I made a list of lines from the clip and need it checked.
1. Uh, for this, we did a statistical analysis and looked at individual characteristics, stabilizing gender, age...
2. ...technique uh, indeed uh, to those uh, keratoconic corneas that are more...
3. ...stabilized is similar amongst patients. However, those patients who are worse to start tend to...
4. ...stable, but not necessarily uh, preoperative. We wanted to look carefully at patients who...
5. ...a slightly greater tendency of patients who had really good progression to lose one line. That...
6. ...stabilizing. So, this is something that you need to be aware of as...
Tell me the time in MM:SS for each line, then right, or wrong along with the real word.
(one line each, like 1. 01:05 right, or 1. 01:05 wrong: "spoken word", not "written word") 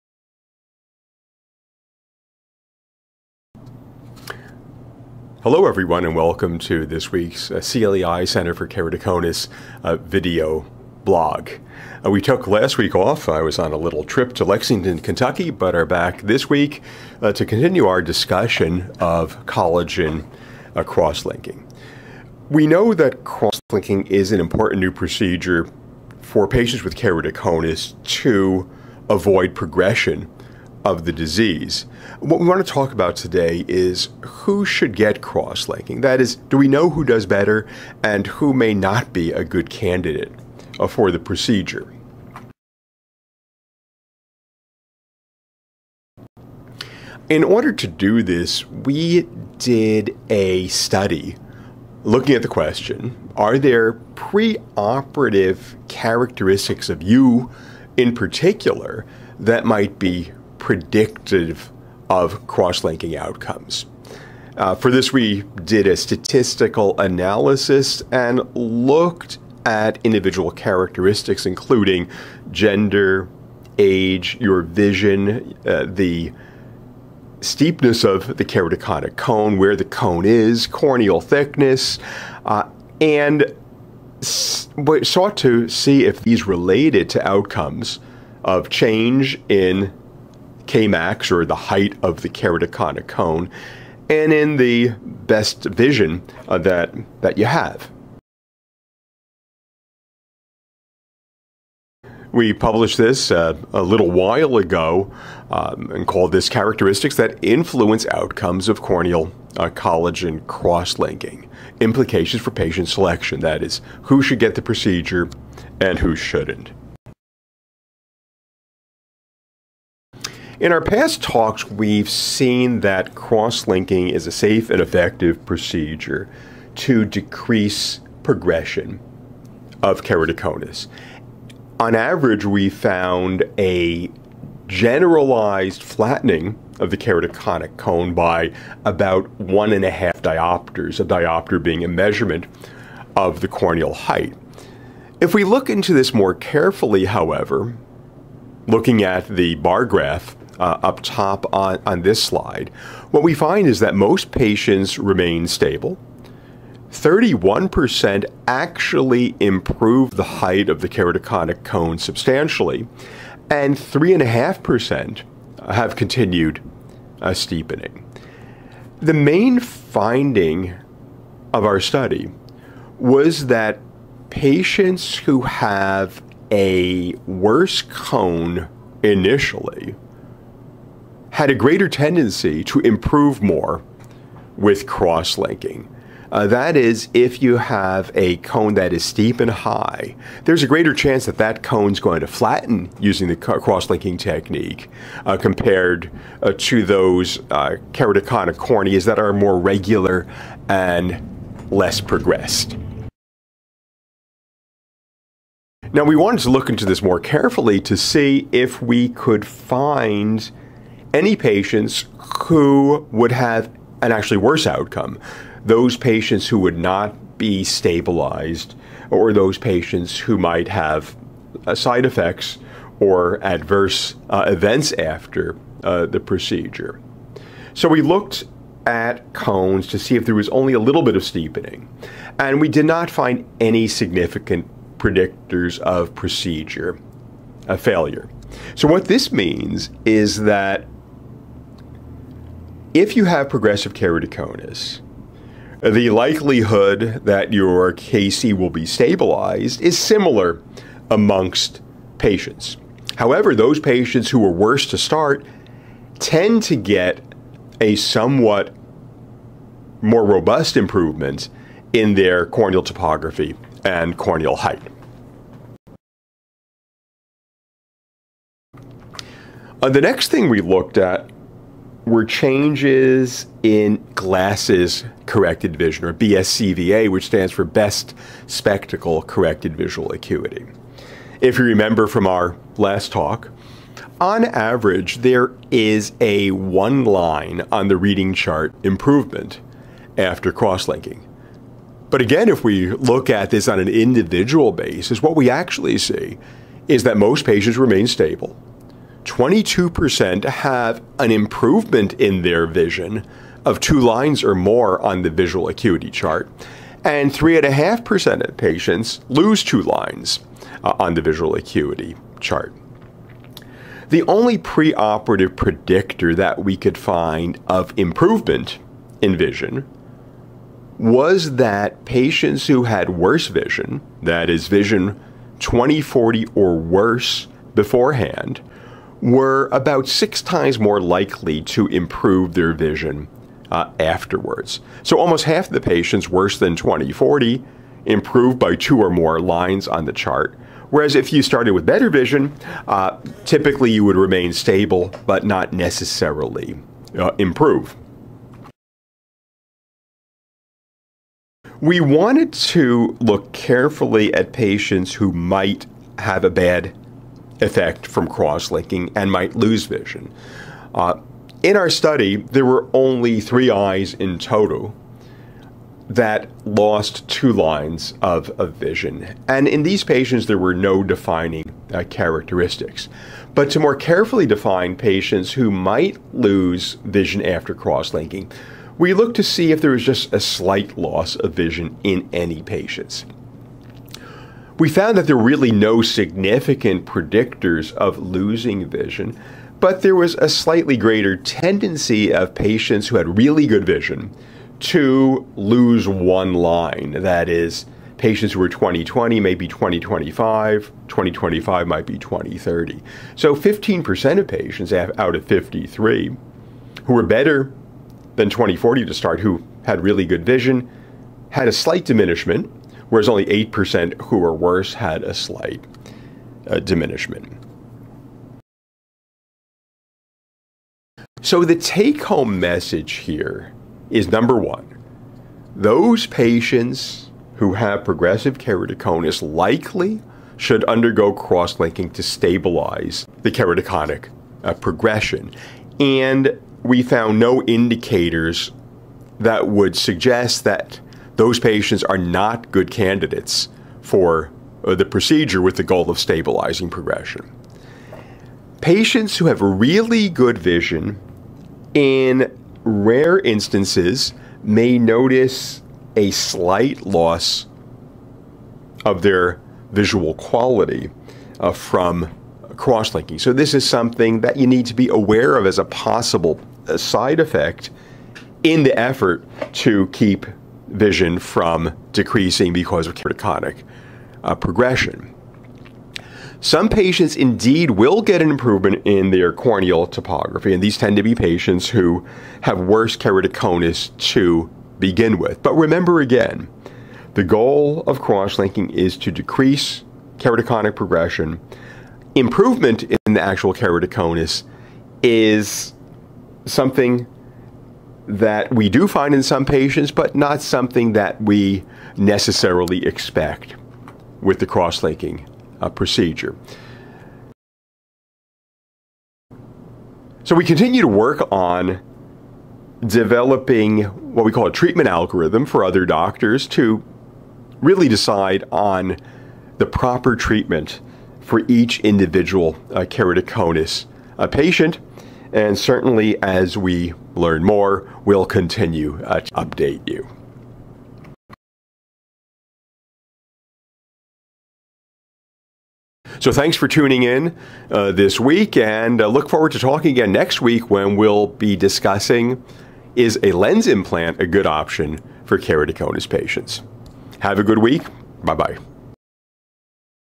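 1. 01:04 wrong: "including", not "stabilizing"
2. 03:14 wrong: "compared", not "indeed"
3. 04:08 right
4. 05:44 wrong: "improve", not "preoperative"
5. 06:30 wrong: "vision", not "progression"
6. 07:43 wrong: "linking", not "stabilizing".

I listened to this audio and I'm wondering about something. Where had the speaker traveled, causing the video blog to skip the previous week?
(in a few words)
Lexington, Kentucky.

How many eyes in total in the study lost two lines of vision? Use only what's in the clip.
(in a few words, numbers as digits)
3.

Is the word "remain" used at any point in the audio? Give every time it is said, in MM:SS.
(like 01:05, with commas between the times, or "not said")
02:34, 04:57, 05:44.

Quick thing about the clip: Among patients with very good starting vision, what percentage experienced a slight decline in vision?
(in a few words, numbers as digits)
15%.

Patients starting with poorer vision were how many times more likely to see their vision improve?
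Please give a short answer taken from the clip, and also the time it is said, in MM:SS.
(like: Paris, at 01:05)
6 times, at 05:30.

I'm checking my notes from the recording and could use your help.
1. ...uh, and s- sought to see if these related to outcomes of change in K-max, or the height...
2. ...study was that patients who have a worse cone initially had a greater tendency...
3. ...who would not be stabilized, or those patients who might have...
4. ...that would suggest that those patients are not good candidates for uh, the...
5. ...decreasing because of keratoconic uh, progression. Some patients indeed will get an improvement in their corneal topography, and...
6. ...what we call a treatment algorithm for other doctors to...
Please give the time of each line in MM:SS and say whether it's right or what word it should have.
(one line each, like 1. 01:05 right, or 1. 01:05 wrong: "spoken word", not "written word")
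1. 01:22 right
2. 02:51 right
3. 03:36 right
4. 07:19 right
5. 07:52 right
6. 08:34 right.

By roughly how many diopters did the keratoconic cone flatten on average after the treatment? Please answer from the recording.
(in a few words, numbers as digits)
1.5 diopters.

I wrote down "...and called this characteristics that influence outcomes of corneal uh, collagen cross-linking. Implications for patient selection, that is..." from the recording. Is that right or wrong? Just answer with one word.
right.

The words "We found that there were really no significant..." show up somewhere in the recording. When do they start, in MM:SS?
06:24.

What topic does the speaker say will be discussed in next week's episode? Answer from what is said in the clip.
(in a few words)
lens implant.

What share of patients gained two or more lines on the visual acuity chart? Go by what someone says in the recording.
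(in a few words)
22%.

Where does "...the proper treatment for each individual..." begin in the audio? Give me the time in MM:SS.
08:39.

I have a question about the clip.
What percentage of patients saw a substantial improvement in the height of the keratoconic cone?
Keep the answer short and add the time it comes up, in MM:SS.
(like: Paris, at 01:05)
31%, at 02:36.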